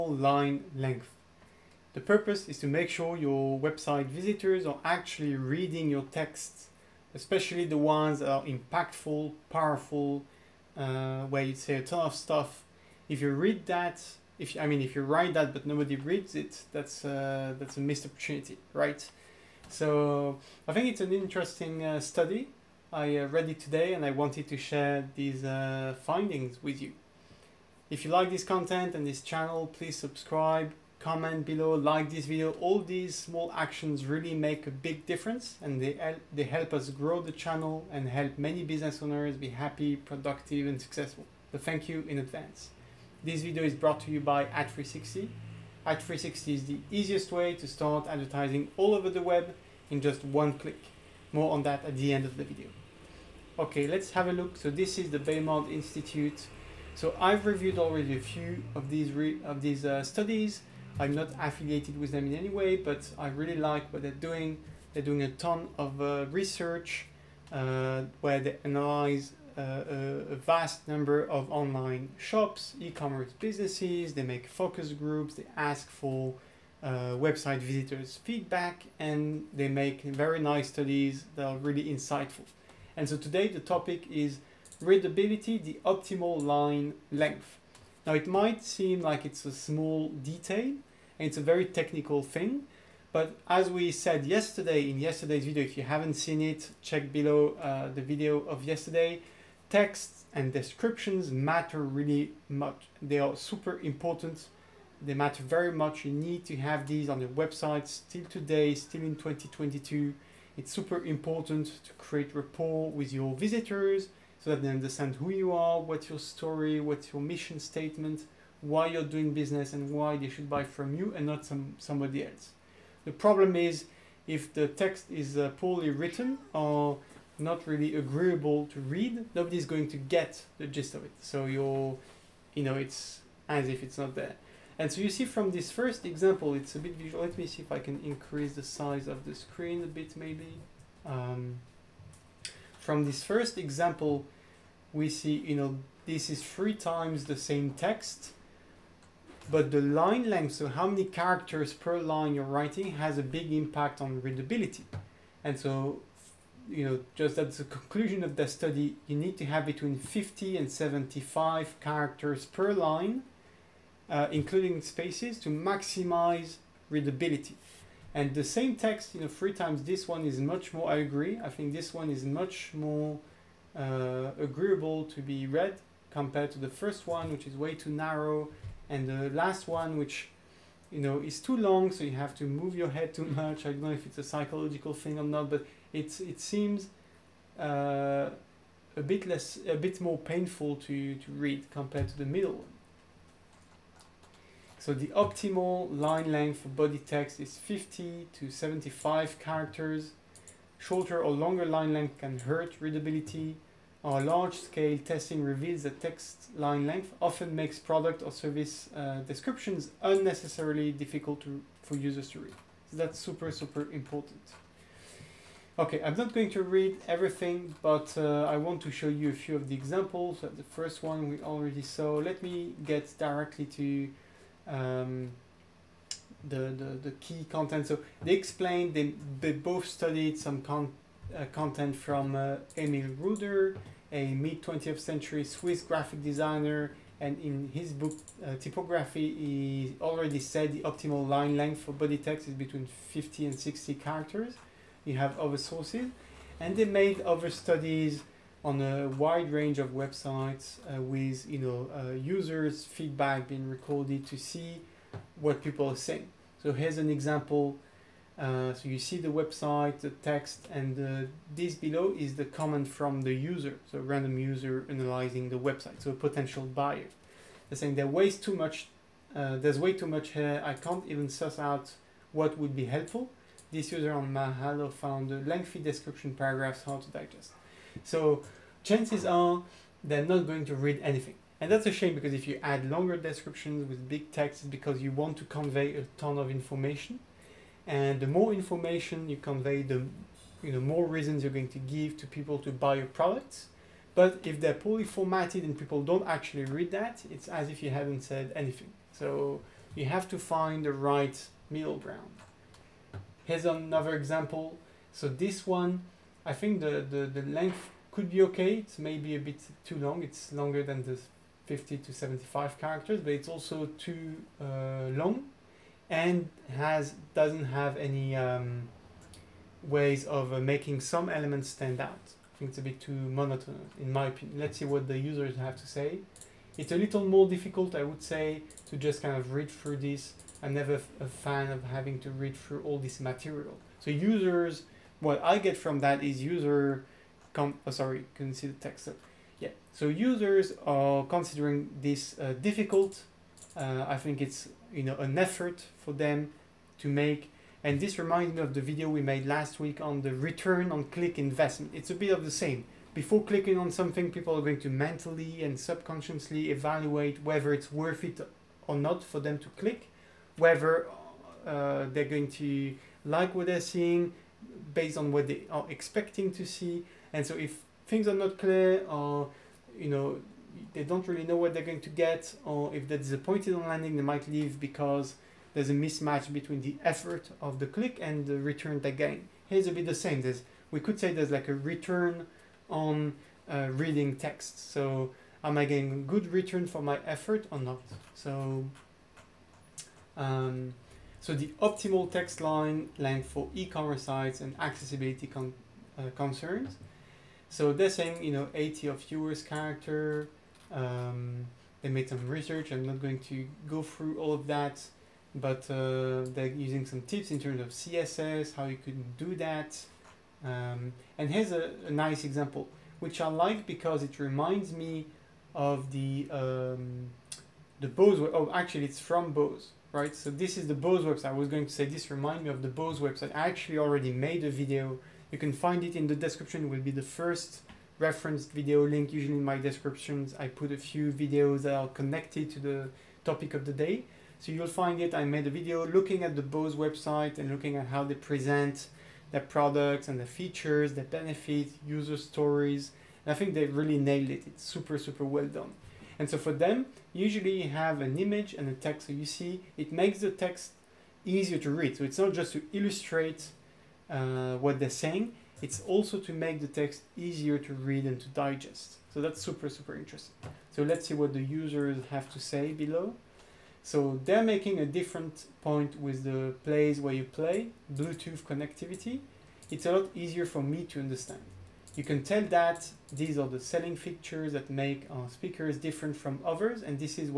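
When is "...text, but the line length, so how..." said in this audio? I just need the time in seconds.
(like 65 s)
147 s.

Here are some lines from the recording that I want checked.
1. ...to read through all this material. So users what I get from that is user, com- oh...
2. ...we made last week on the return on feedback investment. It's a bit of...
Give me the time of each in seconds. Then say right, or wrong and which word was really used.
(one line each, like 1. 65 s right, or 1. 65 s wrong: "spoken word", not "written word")
1. 332 s right
2. 349 s wrong: "click", not "feedback".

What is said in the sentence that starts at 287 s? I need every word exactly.
And the more information you convey, the you know more reasons you're going to give to people to buy your products.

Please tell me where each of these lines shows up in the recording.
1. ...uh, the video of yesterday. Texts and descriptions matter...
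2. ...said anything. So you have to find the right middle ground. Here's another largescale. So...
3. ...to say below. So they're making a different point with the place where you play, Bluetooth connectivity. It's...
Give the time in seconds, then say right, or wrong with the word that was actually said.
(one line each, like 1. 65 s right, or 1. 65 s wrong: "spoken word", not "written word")
1. 97 s right
2. 298 s wrong: "example", not "largescale"
3. 462 s right.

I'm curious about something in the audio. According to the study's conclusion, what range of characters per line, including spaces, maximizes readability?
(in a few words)
50 to 75.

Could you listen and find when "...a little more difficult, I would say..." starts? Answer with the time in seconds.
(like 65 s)
326 s.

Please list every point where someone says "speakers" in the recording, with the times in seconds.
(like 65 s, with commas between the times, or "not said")
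475 s.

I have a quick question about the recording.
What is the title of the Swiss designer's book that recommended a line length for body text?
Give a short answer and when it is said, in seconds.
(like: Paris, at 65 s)
Typography, at 238 s.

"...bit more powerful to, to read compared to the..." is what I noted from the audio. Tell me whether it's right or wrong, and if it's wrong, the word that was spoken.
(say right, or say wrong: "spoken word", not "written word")
wrong: "painful", not "powerful".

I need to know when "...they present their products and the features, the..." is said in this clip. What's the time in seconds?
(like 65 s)
438 s.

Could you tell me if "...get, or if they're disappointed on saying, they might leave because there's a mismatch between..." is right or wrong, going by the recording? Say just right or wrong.
wrong.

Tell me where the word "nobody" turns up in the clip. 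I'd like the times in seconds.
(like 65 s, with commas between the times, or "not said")
15 s, 129 s.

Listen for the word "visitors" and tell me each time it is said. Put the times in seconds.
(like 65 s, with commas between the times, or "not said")
4 s, 77 s, 113 s.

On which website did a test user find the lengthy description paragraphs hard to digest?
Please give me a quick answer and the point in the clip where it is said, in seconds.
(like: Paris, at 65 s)
Mahalo, at 274 s.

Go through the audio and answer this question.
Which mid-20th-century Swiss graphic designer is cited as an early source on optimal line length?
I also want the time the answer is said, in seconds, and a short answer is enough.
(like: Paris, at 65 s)
Emil Ruder, at 232 s.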